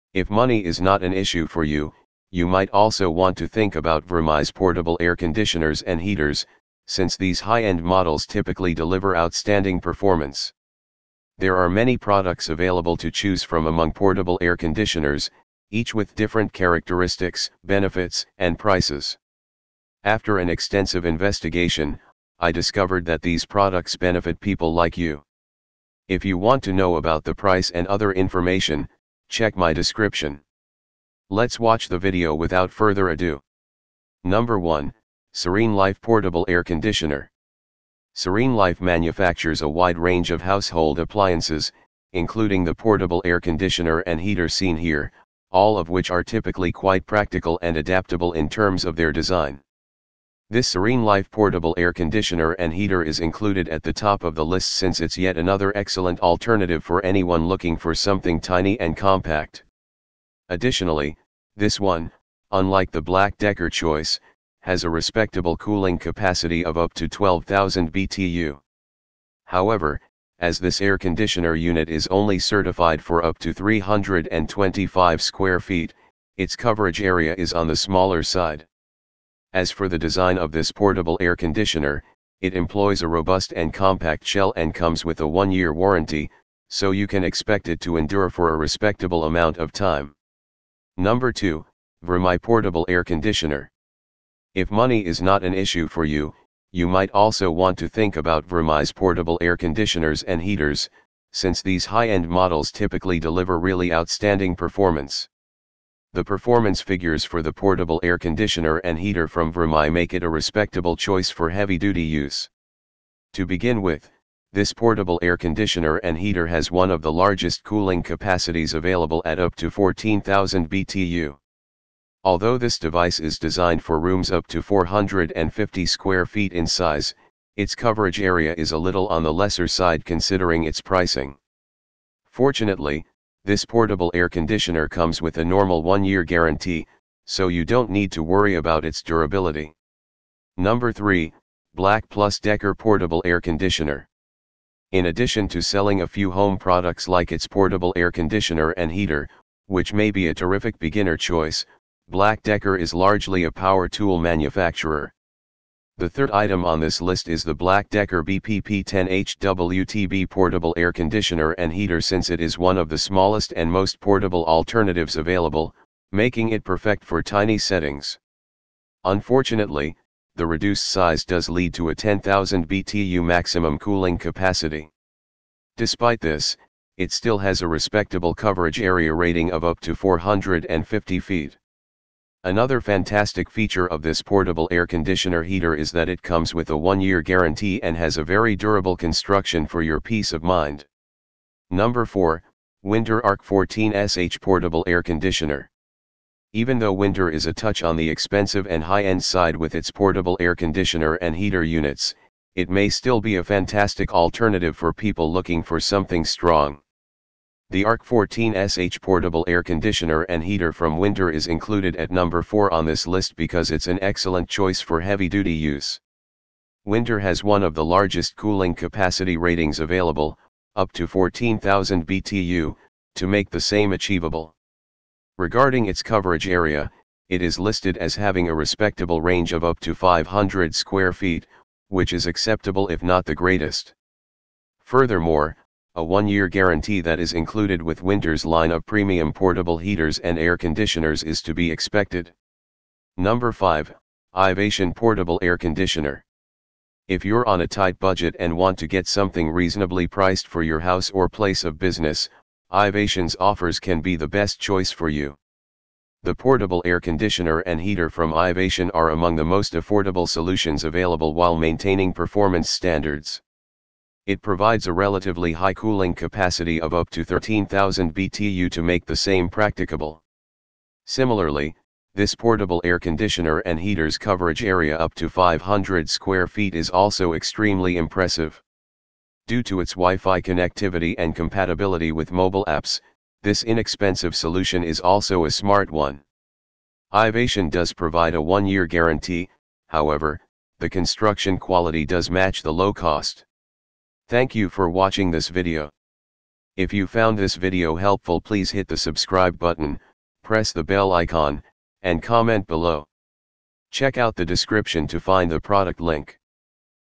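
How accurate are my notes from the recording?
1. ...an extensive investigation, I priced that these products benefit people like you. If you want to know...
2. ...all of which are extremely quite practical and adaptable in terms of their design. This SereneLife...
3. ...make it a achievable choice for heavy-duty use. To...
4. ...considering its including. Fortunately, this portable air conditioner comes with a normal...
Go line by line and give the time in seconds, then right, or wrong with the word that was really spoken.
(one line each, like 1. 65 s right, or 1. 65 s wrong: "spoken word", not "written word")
1. 20 s wrong: "discovered", not "priced"
2. 45 s wrong: "typically", not "extremely"
3. 109 s wrong: "respectable", not "achievable"
4. 130 s wrong: "pricing", not "including".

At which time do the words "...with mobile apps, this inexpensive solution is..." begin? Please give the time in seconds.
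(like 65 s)
282 s.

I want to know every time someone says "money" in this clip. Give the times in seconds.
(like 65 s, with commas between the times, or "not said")
0 s, 94 s.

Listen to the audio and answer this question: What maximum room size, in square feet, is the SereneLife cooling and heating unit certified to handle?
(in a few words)
325 square feet.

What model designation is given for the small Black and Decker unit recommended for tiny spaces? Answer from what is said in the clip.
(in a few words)
BPP-10HWTB.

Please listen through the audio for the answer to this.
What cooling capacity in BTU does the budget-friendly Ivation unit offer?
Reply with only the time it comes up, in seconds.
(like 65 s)
267 s.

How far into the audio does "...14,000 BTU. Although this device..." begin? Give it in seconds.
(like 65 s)
119 s.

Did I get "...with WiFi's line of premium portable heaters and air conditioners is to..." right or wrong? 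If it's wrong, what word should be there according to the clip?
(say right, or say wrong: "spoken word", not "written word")
wrong: "Whynter", not "WiFi".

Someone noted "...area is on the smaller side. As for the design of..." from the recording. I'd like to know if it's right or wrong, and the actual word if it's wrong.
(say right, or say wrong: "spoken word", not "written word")
right.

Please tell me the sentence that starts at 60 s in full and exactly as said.
Additionally, this one, unlike the Black Decker choice, has a respectable cooling capacity of up to 12,000 BTU.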